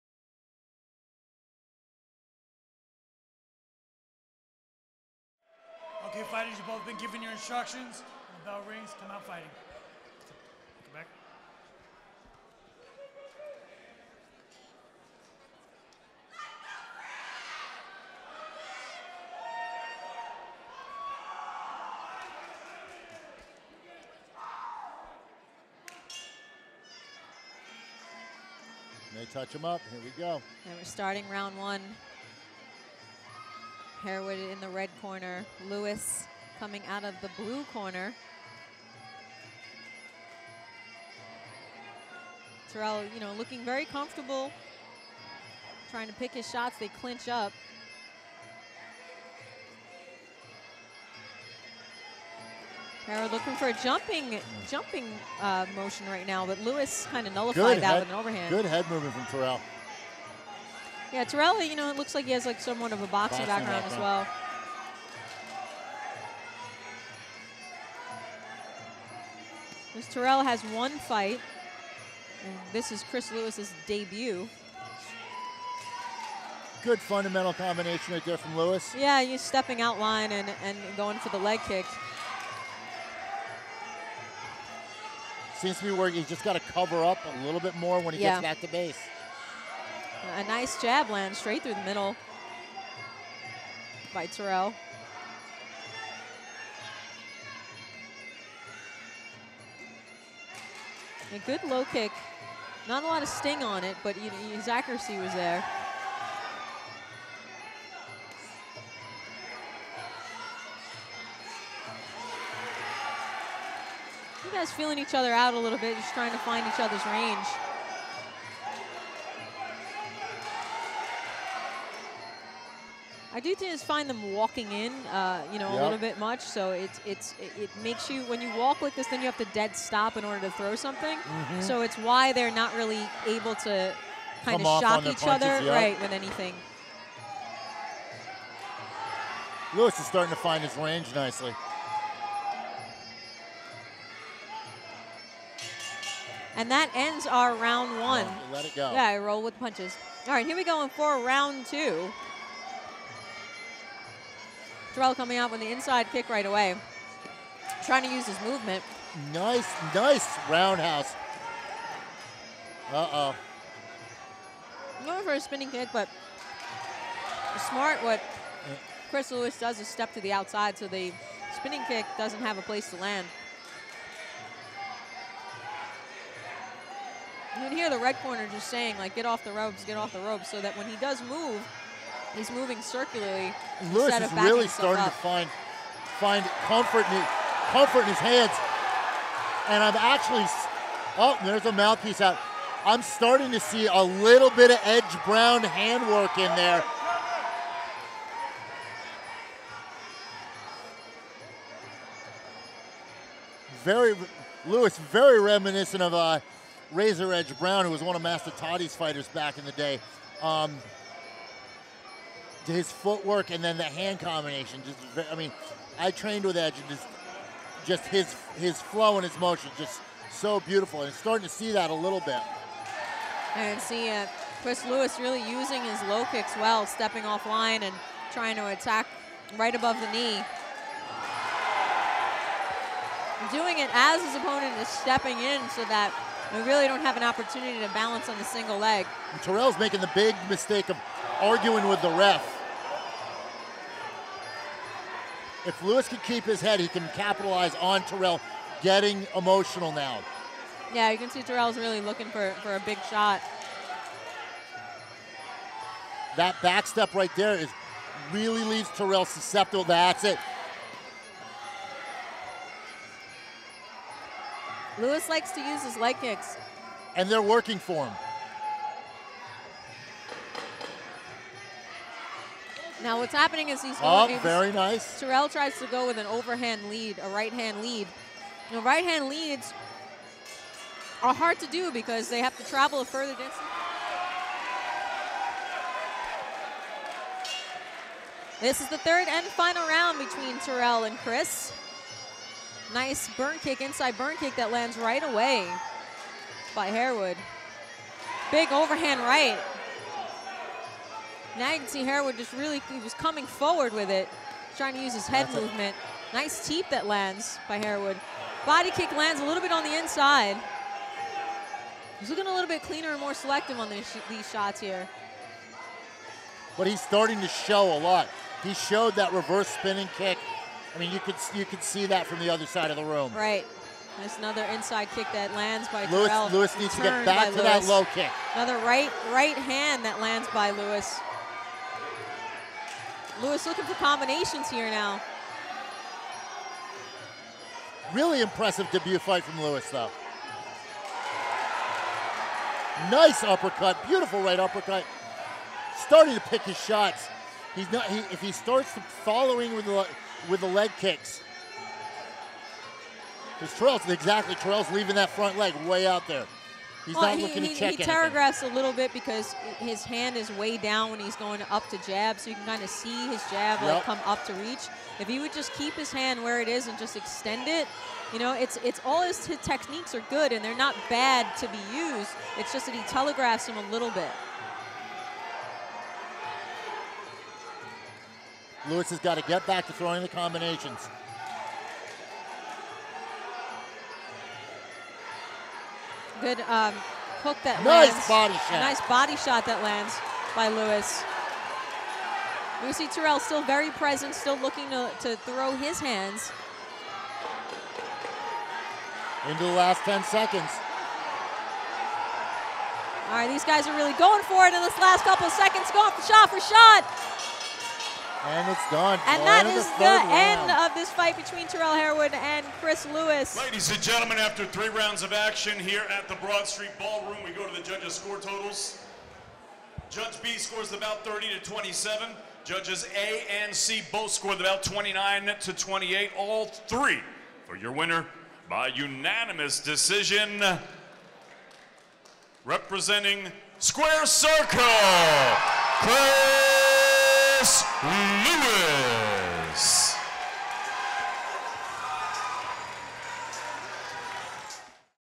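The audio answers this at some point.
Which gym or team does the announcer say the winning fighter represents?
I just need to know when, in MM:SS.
07:13.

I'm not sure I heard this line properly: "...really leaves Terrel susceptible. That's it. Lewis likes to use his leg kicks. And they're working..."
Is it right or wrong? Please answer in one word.
right.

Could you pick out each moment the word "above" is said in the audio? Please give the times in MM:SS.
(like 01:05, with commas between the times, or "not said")
03:49.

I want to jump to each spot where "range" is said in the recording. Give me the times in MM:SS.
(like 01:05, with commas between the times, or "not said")
01:57, 02:20.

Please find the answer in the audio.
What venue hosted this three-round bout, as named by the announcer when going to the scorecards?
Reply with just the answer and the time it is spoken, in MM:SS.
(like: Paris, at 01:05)
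Broad Street Ballroom, at 06:56.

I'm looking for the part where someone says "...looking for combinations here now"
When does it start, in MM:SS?
05:33.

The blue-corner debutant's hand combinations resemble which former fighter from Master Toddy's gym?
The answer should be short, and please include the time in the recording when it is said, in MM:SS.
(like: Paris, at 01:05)
Razor Edge Brown, at 03:26.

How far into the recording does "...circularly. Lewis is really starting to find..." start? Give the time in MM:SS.
03:02.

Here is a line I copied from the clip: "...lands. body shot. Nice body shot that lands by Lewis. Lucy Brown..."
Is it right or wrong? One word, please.
wrong.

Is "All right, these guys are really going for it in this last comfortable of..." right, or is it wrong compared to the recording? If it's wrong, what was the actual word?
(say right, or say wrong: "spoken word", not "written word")
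wrong: "couple", not "comfortable".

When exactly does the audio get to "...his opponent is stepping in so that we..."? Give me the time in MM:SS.
03:54.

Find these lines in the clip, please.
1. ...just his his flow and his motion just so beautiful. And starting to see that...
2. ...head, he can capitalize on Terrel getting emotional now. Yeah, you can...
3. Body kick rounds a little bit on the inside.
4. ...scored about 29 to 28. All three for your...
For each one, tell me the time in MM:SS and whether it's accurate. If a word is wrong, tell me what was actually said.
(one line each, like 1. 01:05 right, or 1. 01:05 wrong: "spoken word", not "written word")
1. 03:37 right
2. 04:06 right
3. 05:08 wrong: "lands", not "rounds"
4. 07:04 right.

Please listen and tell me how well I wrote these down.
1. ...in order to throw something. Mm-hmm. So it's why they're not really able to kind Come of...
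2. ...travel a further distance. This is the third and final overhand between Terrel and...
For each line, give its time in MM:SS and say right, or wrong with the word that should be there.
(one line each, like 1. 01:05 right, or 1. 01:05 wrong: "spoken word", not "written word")
1. 02:10 right
2. 04:42 wrong: "round", not "overhand".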